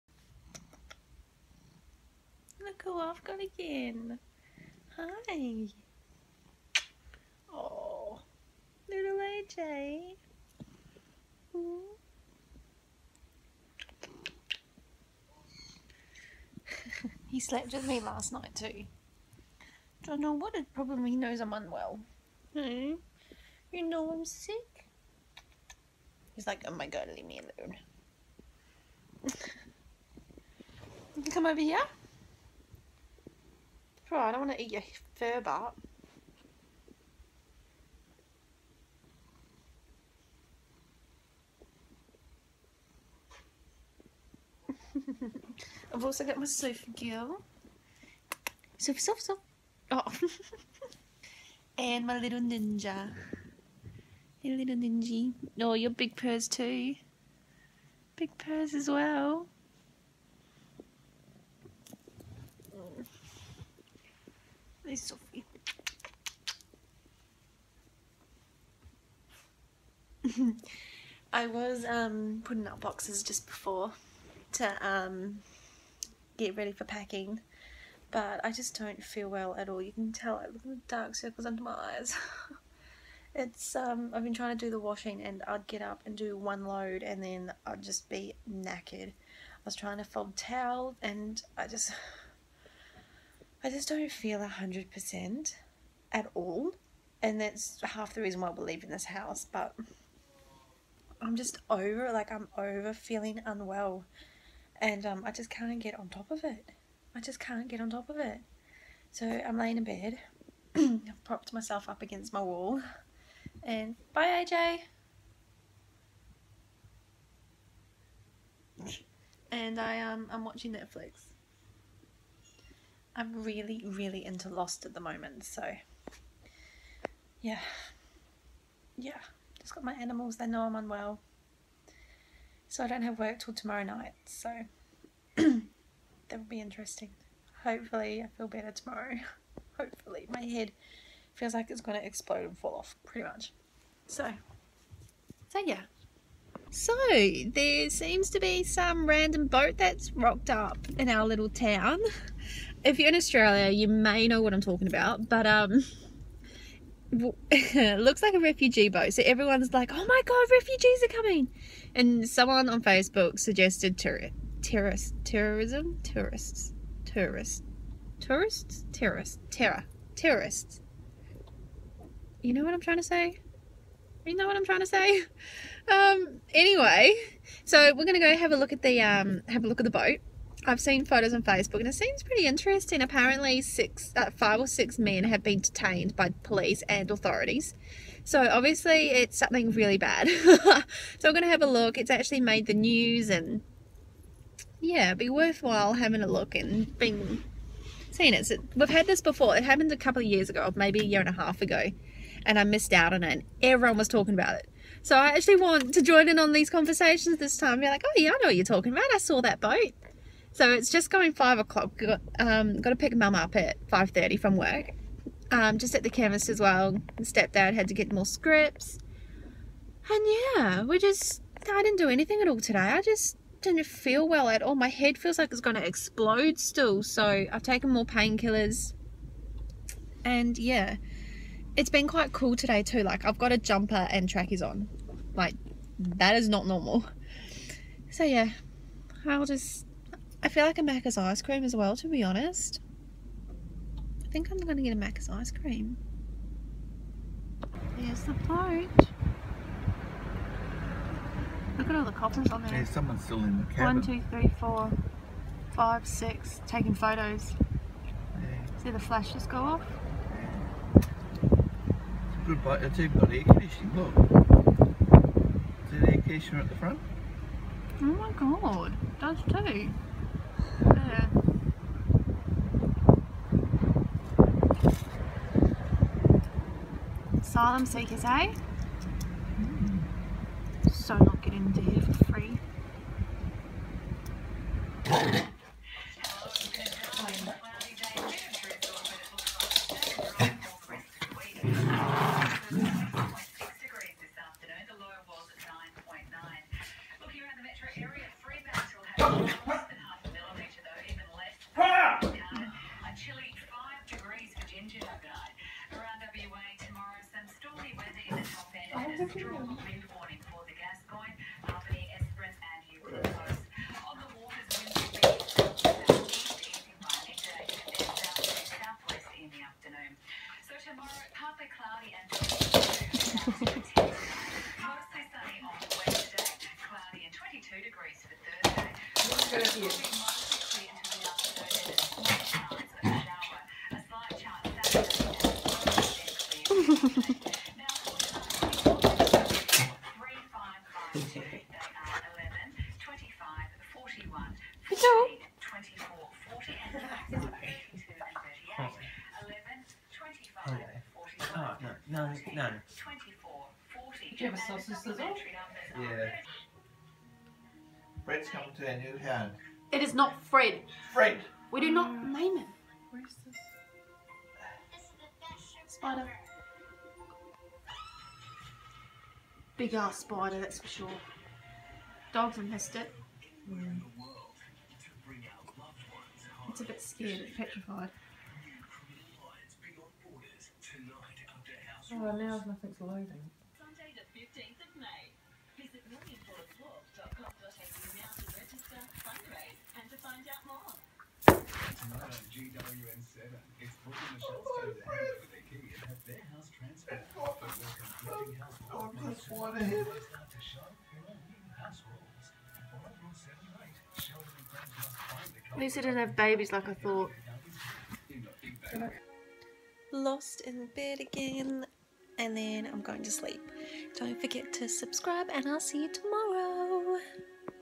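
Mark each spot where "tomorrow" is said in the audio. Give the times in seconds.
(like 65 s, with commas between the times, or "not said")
133 s, 138 s, 320 s, 416 s.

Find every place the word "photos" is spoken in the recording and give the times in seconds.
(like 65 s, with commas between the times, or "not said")
181 s, 256 s.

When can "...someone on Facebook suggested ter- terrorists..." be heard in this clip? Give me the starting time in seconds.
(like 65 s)
162 s.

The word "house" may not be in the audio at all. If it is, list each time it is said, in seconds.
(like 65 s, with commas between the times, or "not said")
99 s.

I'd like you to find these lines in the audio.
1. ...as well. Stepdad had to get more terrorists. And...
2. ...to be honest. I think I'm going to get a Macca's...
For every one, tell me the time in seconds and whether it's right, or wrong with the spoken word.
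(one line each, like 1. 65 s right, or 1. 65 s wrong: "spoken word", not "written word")
1. 216 s wrong: "scripts", not "terrorists"
2. 241 s right.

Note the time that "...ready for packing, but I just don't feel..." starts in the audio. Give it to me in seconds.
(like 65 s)
76 s.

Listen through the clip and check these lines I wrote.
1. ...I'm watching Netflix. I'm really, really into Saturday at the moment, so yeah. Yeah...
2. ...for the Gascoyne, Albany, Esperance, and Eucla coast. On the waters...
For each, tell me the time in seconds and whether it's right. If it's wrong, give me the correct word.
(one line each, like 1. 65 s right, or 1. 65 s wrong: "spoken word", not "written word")
1. 120 s wrong: "Lost", not "Saturday"
2. 310 s right.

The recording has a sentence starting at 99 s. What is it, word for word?
But I'm just over, like, I'm over feeling unwell.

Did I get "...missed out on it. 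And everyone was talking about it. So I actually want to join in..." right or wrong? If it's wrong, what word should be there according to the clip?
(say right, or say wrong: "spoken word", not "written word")
right.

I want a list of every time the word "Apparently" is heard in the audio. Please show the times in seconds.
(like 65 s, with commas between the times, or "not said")
183 s.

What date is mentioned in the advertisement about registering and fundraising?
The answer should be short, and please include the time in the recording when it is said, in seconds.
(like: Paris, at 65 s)
Sunday the 15th of May, at 383 s.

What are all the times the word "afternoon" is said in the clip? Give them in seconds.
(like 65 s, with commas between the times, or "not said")
319 s, 332 s.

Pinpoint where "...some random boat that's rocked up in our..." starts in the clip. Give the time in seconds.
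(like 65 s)
148 s.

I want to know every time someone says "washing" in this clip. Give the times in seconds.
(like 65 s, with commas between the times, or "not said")
84 s.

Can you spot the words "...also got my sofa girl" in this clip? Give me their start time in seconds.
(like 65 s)
46 s.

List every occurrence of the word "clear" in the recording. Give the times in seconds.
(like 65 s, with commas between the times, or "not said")
330 s, 337 s.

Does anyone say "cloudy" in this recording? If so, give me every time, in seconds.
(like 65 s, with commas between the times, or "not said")
321 s, 326 s.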